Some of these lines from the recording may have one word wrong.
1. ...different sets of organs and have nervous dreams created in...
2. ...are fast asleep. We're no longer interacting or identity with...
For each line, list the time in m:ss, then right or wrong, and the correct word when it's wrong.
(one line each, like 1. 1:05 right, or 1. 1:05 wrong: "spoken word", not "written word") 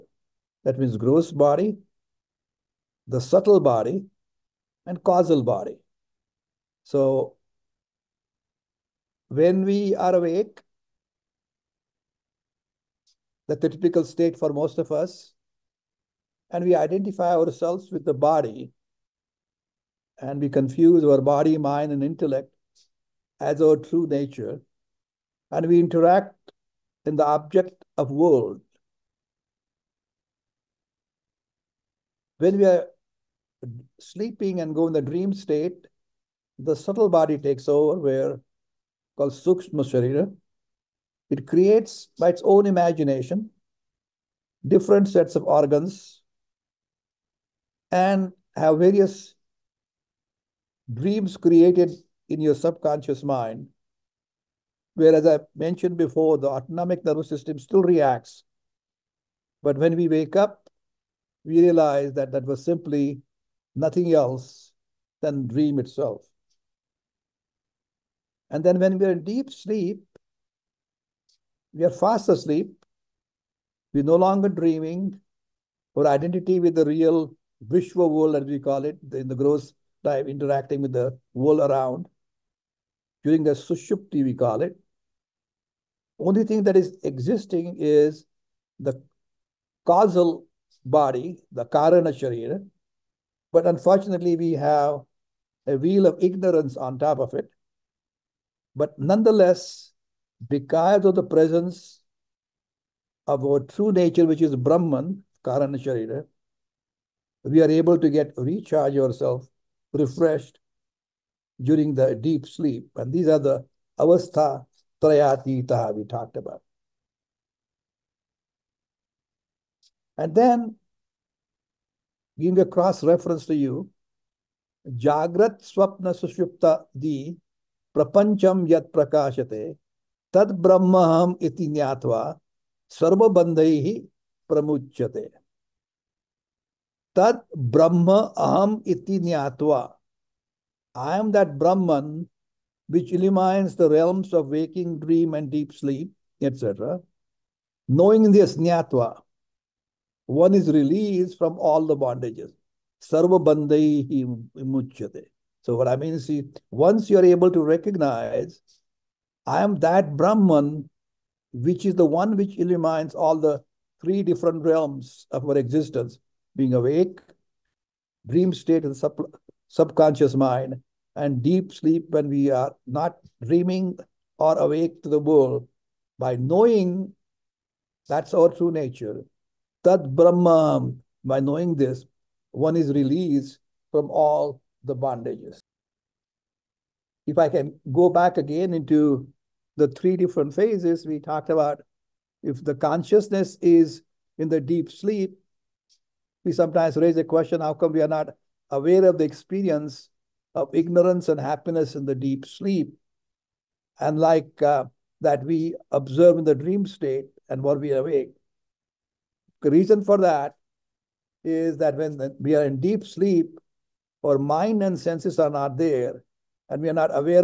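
1. 0:44 wrong: "various", not "nervous"
2. 1:11 wrong: "dreaming", not "interacting".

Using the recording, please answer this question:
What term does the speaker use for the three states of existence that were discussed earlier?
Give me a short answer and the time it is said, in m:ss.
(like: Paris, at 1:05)
Avastha trayatitaha, at 1:53.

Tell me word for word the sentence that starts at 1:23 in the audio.
During the sushupti, we call it.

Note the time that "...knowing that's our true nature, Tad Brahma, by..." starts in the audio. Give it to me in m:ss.
2:56.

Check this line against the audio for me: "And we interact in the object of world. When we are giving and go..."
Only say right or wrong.
wrong.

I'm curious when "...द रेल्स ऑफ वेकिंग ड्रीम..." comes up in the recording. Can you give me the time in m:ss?
2:23.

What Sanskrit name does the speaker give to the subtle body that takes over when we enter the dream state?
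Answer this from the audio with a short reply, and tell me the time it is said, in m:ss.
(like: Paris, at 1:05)
Sukshma Sharira, at 0:39.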